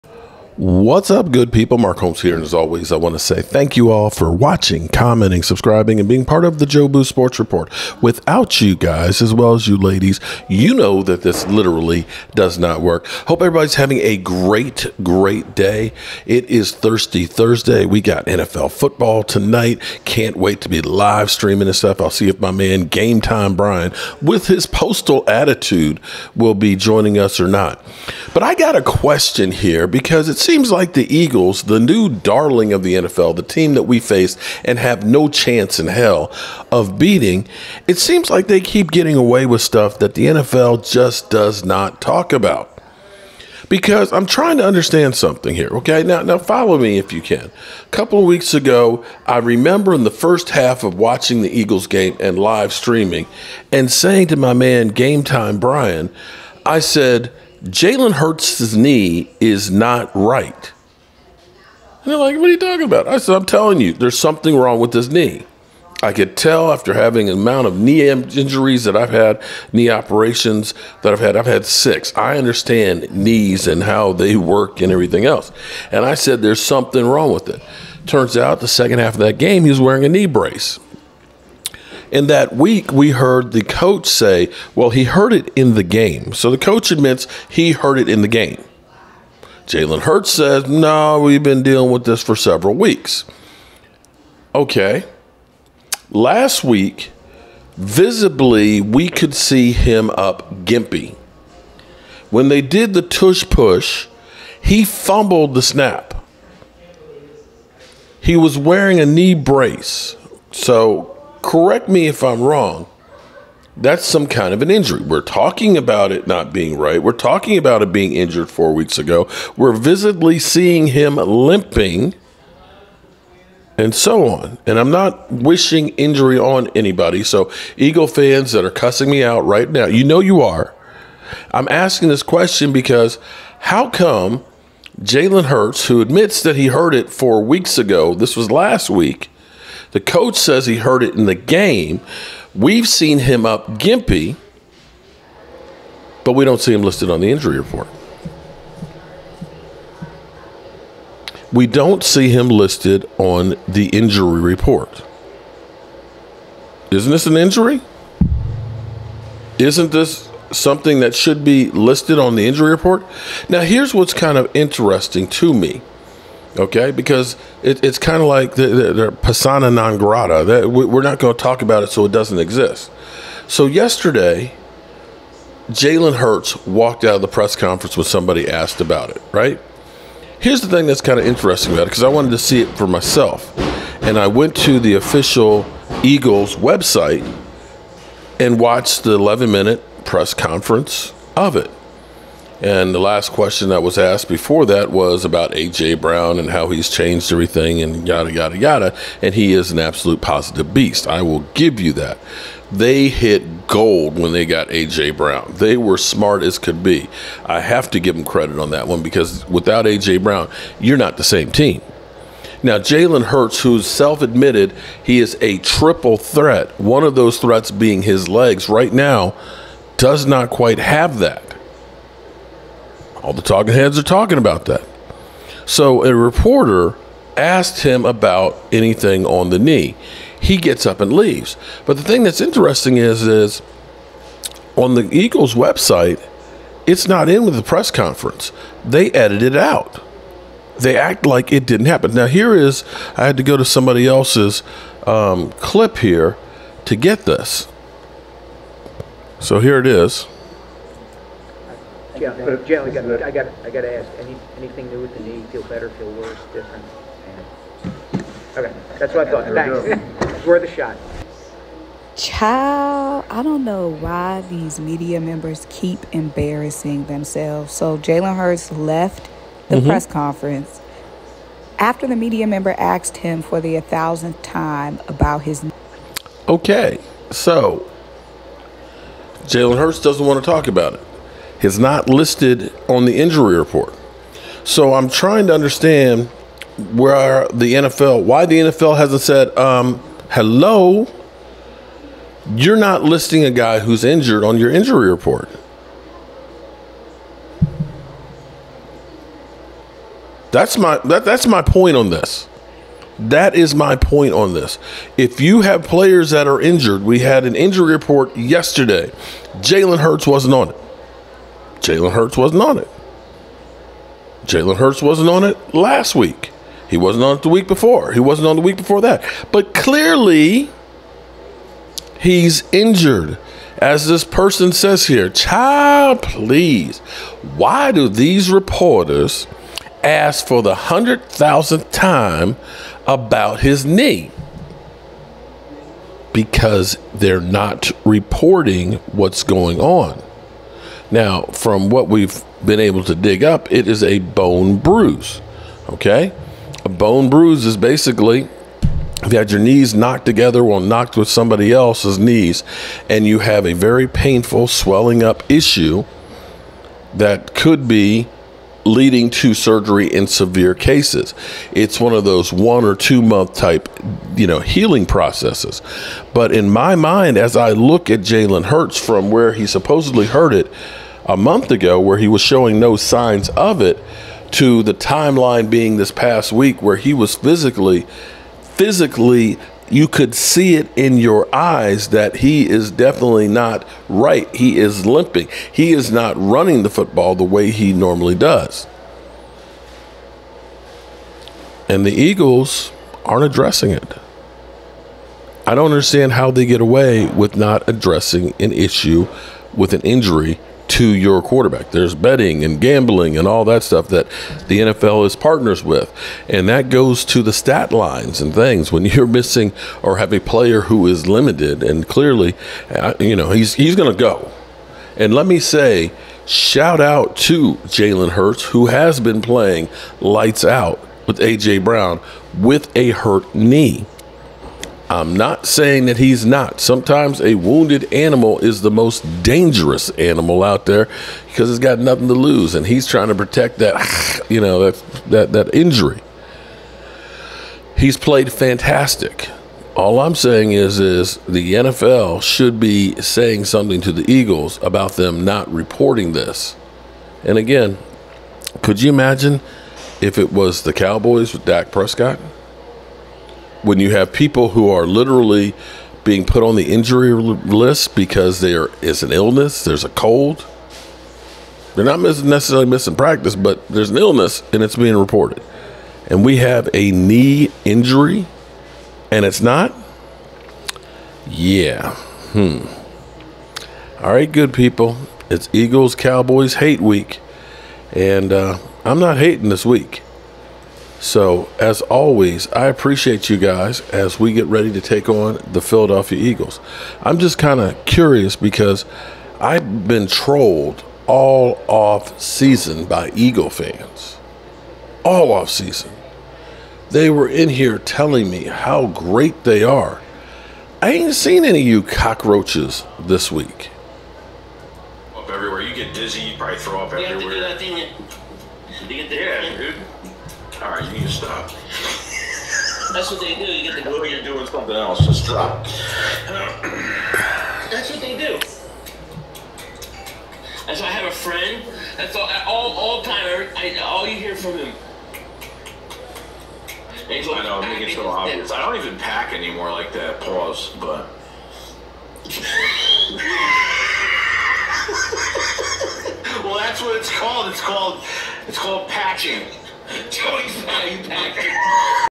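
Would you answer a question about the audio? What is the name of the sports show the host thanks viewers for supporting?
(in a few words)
Jobu Sports Report.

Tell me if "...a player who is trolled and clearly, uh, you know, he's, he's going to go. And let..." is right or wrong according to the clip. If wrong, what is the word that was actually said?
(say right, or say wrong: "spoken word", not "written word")
wrong: "limited", not "trolled".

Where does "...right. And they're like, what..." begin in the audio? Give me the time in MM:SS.
01:00.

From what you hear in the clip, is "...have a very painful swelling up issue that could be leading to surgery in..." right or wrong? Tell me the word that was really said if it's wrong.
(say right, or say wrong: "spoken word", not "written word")
right.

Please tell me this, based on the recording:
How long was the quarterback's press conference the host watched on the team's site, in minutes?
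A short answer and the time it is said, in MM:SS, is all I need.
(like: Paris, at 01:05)
11, at 03:09.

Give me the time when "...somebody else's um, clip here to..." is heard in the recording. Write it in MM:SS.
04:03.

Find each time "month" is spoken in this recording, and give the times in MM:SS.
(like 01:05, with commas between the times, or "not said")
06:03, 06:11.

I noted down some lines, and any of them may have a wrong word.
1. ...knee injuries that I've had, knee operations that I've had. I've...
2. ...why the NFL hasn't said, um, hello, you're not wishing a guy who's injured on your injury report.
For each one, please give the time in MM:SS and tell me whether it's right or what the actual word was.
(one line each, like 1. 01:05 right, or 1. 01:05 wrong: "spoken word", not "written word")
1. 01:07 right
2. 04:48 wrong: "listing", not "wishing".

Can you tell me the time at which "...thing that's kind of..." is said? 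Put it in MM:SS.
03:00.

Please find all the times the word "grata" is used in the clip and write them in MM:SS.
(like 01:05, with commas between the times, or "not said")
02:49.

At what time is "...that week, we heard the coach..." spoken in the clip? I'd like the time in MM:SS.
01:22.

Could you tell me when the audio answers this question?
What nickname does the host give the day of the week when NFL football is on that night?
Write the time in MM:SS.
00:16.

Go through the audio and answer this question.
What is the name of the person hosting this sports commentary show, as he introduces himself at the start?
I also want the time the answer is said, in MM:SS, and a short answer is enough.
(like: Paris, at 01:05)
Mark Holmes, at 00:01.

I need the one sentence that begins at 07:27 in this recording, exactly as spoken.
And again, could you imagine if it was the Cowboys with Dak Prescott?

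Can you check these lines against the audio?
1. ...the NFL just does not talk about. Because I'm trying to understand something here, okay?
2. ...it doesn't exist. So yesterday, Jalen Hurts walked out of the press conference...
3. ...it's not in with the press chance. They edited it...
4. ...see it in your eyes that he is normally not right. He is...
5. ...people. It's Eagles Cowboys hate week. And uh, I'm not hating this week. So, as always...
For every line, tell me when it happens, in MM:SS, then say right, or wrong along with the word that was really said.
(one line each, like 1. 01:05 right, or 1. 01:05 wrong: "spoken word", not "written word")
1. 00:40 right
2. 02:52 right
3. 03:56 wrong: "conference", not "chance"
4. 06:20 wrong: "definitely", not "normally"
5. 07:54 right.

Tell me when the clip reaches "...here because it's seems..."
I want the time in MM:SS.
00:29.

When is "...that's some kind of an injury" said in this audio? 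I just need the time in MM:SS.
01:53.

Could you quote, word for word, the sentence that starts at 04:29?
press conference after the media member asked him for the thousandth time about his.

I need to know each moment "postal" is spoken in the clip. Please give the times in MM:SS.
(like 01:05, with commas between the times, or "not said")
00:24.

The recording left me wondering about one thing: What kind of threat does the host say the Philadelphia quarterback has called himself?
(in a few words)
triple threat.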